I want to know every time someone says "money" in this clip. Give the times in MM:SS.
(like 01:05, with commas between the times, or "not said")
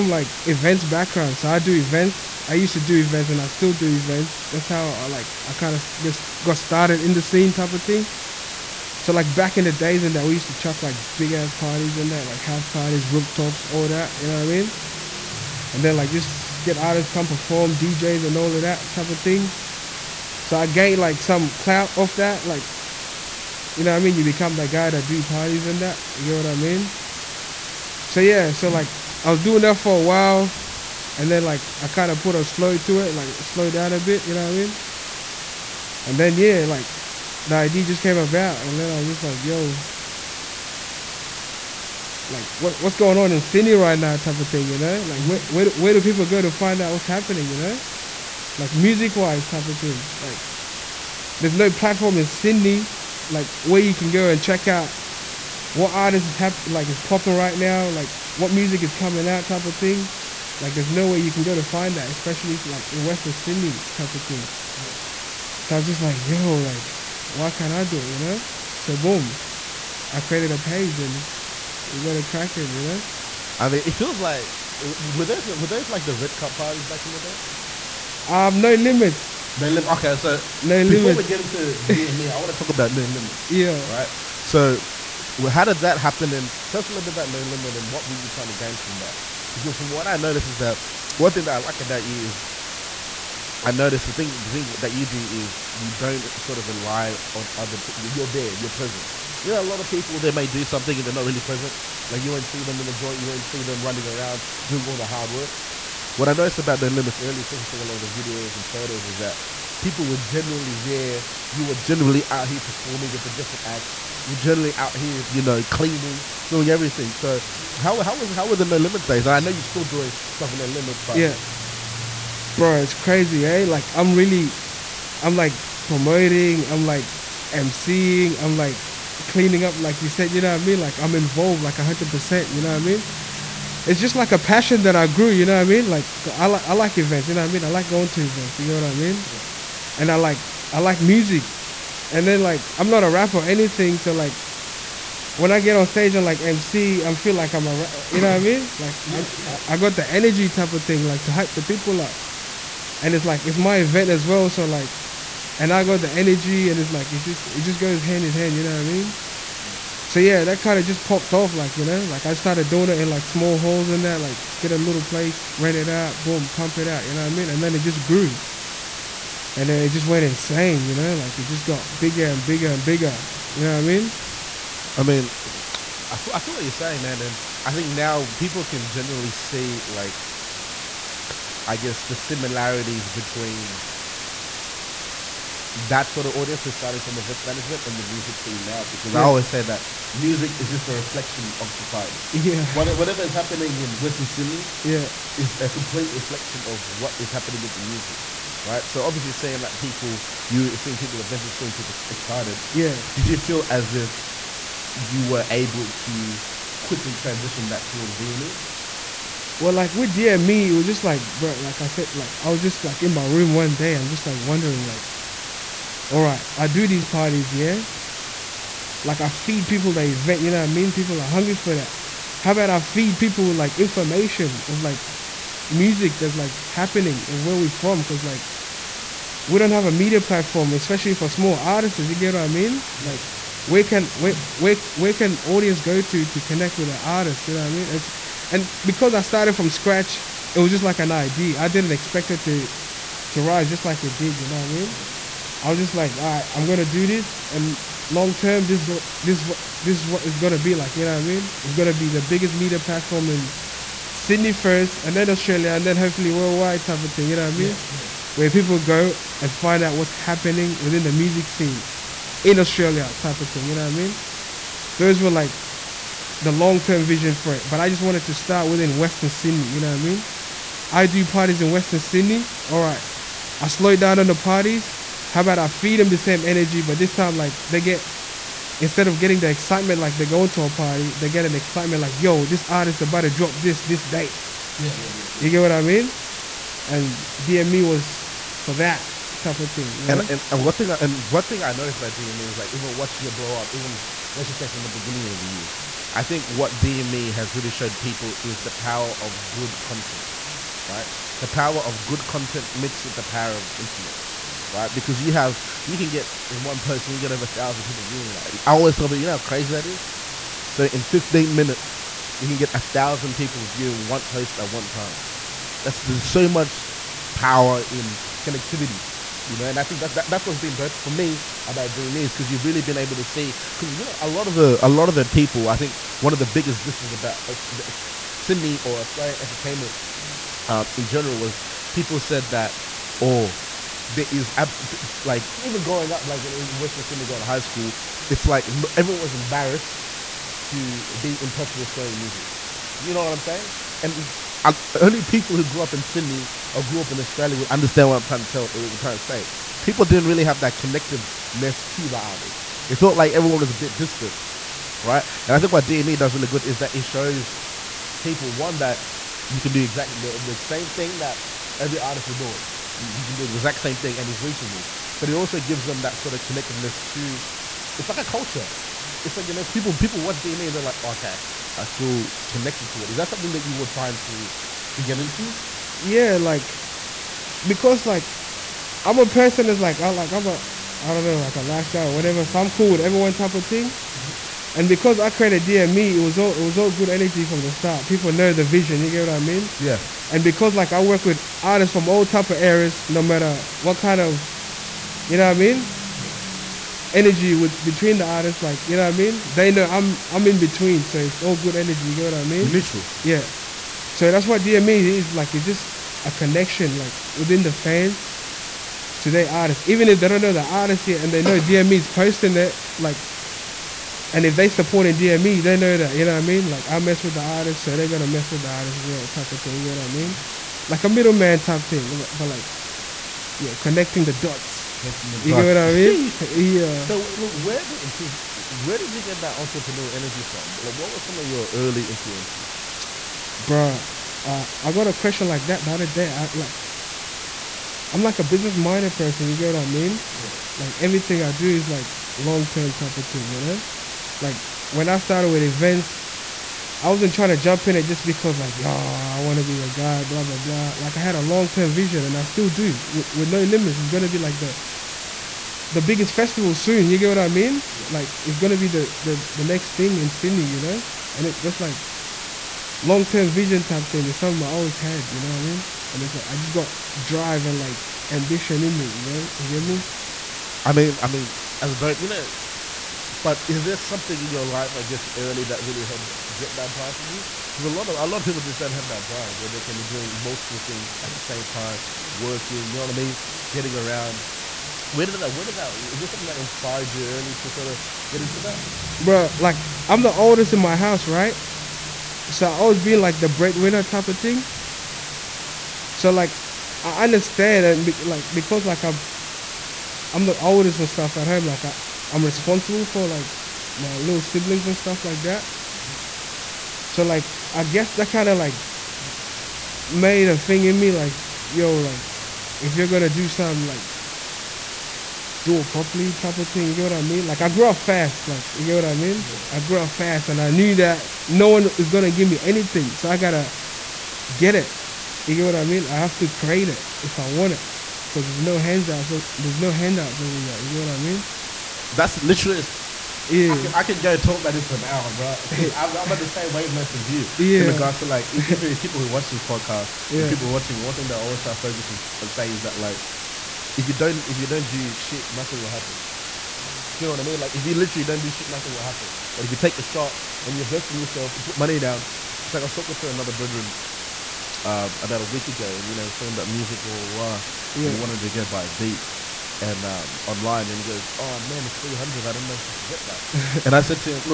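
09:11.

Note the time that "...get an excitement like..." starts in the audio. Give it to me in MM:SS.
04:41.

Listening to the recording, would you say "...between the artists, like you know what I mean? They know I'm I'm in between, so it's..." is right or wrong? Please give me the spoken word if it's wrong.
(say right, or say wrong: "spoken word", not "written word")
right.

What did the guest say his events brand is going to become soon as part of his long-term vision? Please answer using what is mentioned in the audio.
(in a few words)
the biggest festival.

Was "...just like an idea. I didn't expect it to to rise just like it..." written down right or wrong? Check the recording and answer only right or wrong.
right.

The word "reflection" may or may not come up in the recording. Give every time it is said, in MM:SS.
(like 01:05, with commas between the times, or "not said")
03:10, 03:16.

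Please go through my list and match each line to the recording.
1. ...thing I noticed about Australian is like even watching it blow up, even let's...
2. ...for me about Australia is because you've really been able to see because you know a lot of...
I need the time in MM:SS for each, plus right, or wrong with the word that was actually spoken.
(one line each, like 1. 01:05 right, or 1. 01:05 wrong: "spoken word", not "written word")
1. 04:51 wrong: "DME", not "Australian"
2. 05:20 wrong: "DME", not "Australia".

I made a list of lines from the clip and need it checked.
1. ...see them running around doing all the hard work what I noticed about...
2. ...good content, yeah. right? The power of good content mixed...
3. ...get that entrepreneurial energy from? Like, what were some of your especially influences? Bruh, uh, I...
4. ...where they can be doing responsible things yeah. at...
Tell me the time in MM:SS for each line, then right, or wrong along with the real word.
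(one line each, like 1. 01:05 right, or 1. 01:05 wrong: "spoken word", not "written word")
1. 01:43 right
2. 04:59 right
3. 07:09 wrong: "early", not "especially"
4. 07:59 wrong: "multiple", not "responsible".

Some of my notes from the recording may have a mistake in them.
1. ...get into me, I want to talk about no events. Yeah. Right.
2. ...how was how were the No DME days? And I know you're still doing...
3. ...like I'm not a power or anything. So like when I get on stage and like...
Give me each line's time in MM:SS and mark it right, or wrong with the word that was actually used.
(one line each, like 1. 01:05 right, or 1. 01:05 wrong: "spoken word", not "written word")
1. 01:21 wrong: "limits", not "events"
2. 01:57 wrong: "Limits", not "DME"
3. 02:22 wrong: "rapper", not "power".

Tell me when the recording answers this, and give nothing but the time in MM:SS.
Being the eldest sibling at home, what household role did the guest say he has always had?
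08:13.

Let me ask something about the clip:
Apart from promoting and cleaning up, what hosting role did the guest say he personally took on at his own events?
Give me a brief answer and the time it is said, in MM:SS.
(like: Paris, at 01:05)
emceeing, at 02:07.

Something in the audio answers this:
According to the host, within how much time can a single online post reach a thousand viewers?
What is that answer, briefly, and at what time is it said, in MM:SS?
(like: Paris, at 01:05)
15 minutes, at 05:11.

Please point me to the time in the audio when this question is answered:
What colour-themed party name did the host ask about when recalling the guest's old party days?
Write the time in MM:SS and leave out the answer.
01:16.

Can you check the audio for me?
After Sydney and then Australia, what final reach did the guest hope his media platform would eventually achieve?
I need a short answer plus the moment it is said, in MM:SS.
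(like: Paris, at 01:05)
worldwide, at 04:16.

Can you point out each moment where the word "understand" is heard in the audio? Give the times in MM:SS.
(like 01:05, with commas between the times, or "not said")
05:47, 08:17.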